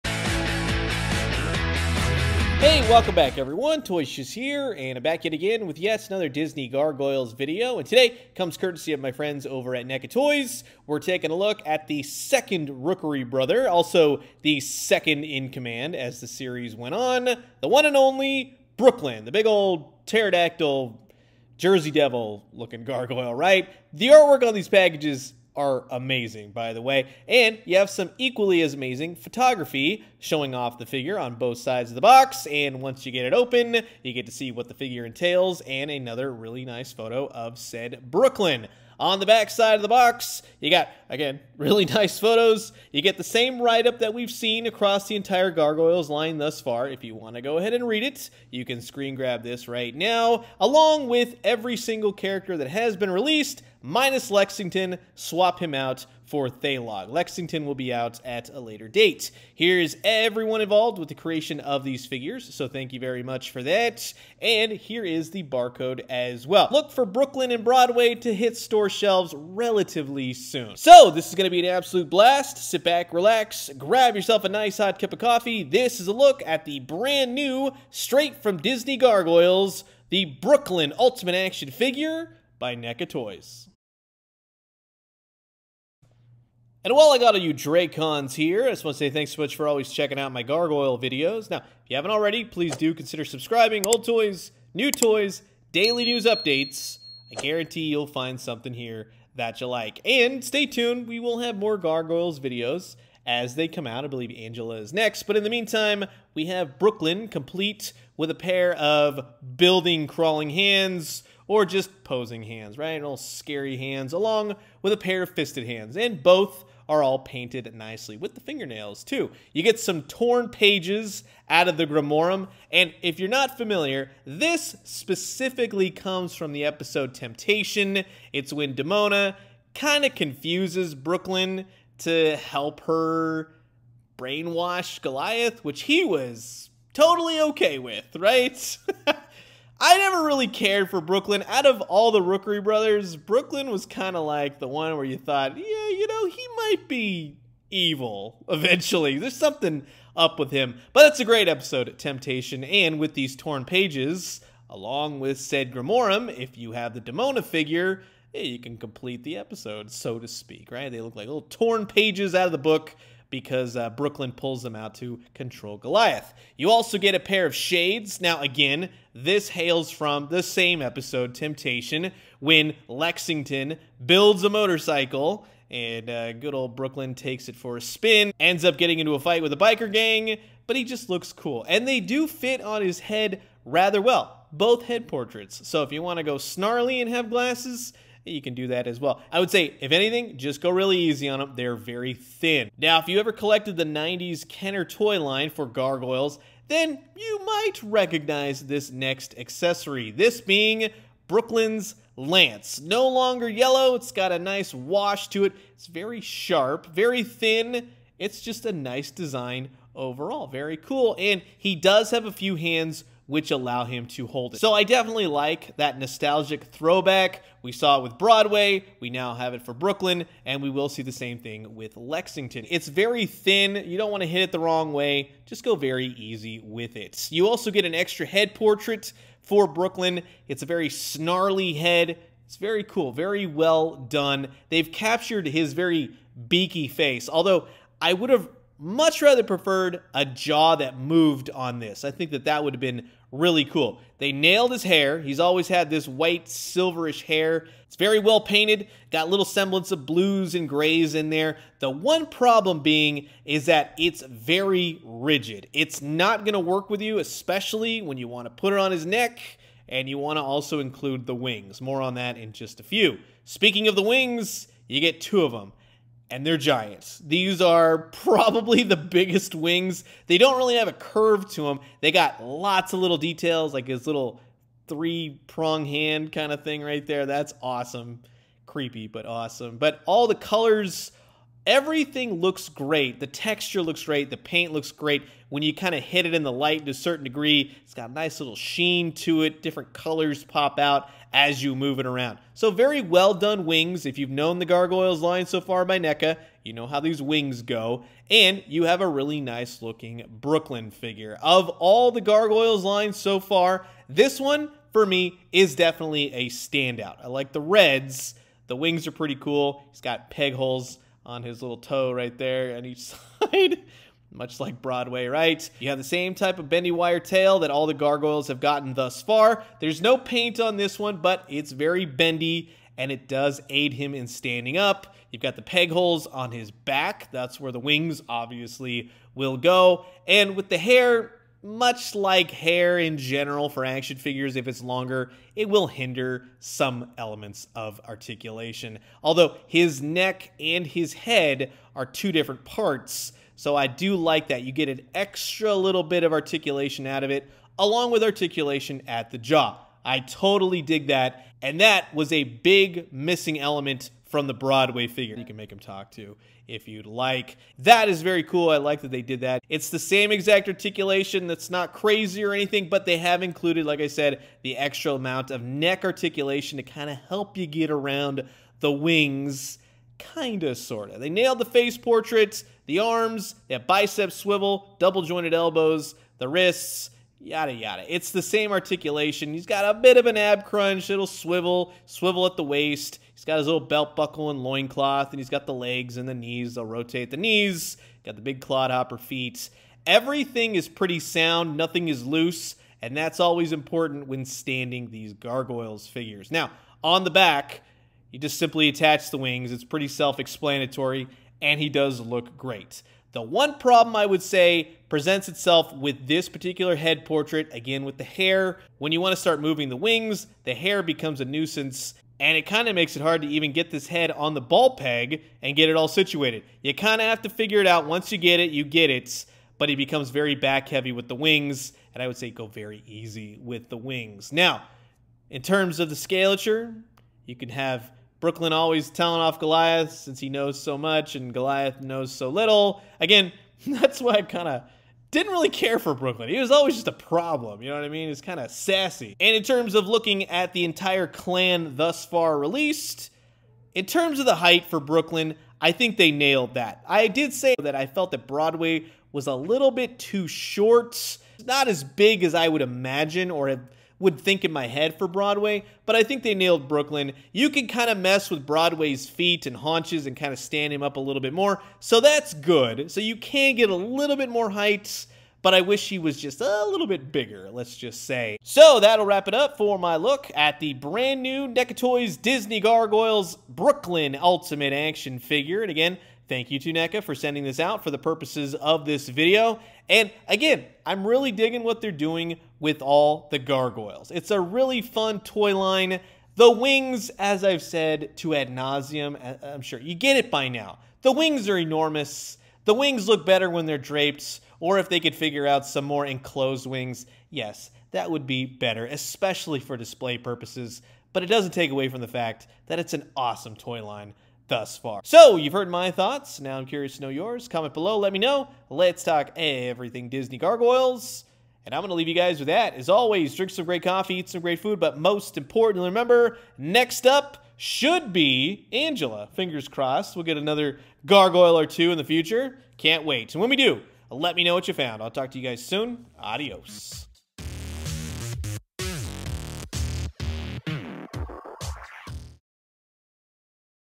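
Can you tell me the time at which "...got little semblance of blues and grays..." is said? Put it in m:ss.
4:09.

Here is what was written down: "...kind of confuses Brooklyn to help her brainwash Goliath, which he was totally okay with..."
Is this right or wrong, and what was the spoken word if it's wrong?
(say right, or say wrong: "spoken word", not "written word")
right.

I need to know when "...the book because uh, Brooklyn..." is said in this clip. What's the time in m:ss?
2:42.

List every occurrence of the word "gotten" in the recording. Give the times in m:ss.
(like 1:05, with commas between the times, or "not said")
5:18.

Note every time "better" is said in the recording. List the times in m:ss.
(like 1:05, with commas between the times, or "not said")
8:13, 8:18.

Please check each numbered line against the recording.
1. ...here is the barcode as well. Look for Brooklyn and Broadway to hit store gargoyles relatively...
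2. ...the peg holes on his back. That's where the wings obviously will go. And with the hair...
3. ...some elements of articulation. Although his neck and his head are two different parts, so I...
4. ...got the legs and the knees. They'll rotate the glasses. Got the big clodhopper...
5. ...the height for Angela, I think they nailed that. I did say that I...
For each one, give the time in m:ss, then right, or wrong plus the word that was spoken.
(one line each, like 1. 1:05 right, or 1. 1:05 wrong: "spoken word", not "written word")
1. 1:04 wrong: "shelves", not "gargoyles"
2. 5:25 right
3. 5:36 right
4. 6:25 wrong: "knees", not "glasses"
5. 7:24 wrong: "Brooklyn", not "Angela".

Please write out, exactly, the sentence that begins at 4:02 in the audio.
I think that that would have been really cool.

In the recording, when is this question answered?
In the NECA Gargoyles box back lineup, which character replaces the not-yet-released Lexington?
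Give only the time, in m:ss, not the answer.
0:56.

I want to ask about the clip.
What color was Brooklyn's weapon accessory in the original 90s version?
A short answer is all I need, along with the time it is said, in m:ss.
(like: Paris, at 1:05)
Yellow, at 3:23.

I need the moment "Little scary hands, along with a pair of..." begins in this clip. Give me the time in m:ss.
1:52.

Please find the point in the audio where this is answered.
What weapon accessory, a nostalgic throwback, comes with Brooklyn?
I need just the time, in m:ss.
3:22.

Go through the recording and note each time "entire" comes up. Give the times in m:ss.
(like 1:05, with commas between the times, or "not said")
0:45, 7:20.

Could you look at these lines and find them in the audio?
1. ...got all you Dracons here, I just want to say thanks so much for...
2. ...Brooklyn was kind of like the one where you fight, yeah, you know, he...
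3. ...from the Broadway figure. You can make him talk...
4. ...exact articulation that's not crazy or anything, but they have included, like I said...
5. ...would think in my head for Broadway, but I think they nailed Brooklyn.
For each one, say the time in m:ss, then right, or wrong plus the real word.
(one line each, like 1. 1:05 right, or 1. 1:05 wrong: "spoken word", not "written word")
1. 1:27 right
2. 2:23 wrong: "thought", not "fight"
3. 5:54 right
4. 6:00 right
5. 7:34 right.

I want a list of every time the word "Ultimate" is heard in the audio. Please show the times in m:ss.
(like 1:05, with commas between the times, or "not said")
1:20, 7:54.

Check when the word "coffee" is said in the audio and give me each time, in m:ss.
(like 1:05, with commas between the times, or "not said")
1:15, 8:34.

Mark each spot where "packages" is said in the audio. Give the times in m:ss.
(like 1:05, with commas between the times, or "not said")
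0:24.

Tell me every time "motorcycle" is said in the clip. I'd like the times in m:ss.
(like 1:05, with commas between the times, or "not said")
2:54.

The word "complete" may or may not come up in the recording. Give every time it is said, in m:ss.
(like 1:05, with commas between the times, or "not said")
1:47, 2:38.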